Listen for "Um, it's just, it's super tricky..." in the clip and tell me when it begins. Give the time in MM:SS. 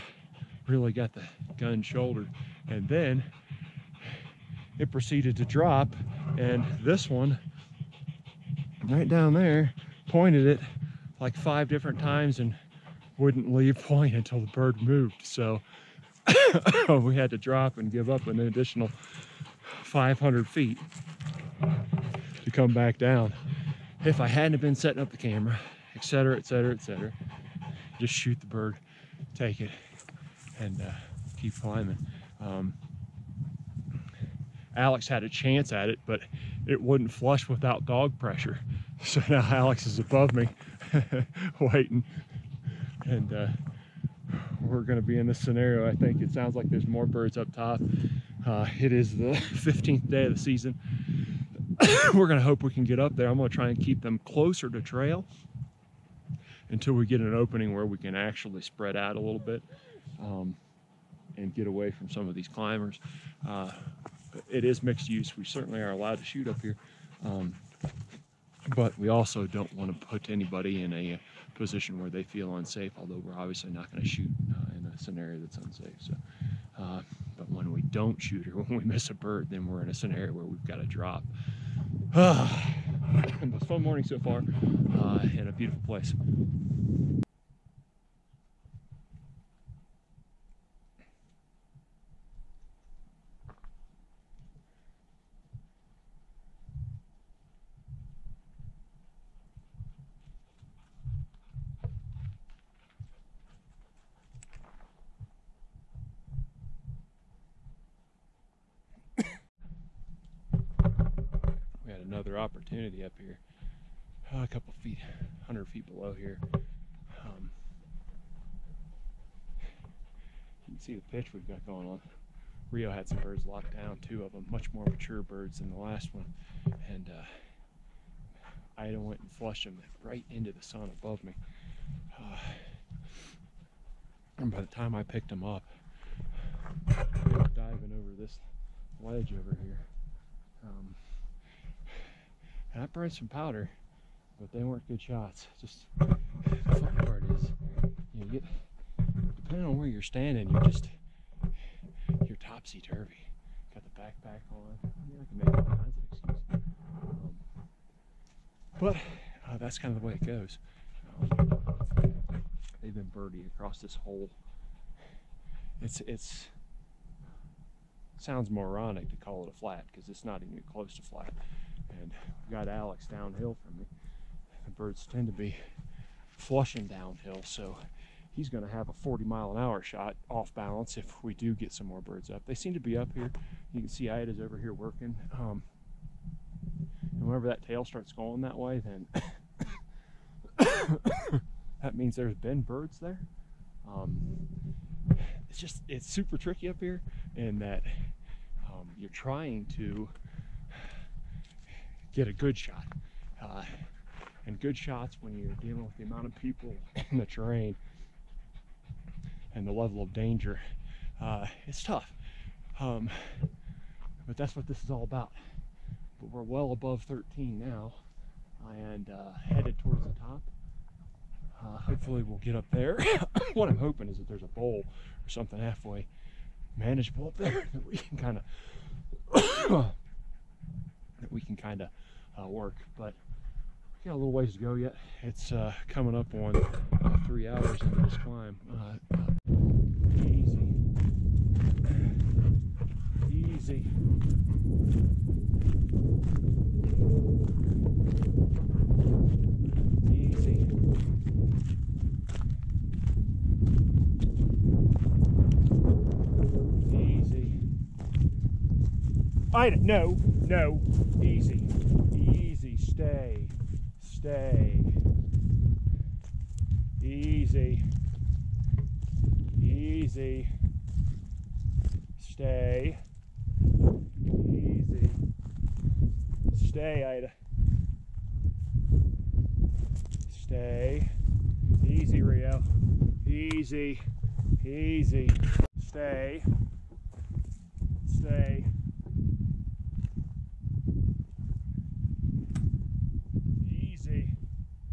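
03:13.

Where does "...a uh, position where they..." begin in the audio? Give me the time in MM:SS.
01:10.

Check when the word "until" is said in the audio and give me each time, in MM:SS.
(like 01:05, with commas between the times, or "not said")
00:14, 00:56.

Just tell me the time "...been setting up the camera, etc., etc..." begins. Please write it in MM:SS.
00:24.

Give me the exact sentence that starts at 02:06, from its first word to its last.
And uh, Ida went and flushed them right into the sun above me.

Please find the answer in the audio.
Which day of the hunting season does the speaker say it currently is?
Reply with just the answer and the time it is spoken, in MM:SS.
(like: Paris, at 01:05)
15th, at 00:49.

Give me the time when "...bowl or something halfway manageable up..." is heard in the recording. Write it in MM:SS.
03:44.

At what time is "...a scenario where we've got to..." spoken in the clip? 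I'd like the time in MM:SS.
01:19.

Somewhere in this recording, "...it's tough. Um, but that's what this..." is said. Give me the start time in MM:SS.
03:31.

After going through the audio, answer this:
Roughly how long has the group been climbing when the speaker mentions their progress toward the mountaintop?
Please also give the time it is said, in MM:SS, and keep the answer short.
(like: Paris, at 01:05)
3 hours, at 03:57.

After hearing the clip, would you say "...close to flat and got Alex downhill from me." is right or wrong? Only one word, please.
right.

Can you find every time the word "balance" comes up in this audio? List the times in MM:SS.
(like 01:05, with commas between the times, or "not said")
03:00.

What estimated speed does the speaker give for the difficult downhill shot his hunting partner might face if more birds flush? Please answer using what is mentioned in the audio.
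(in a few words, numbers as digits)
40 mph.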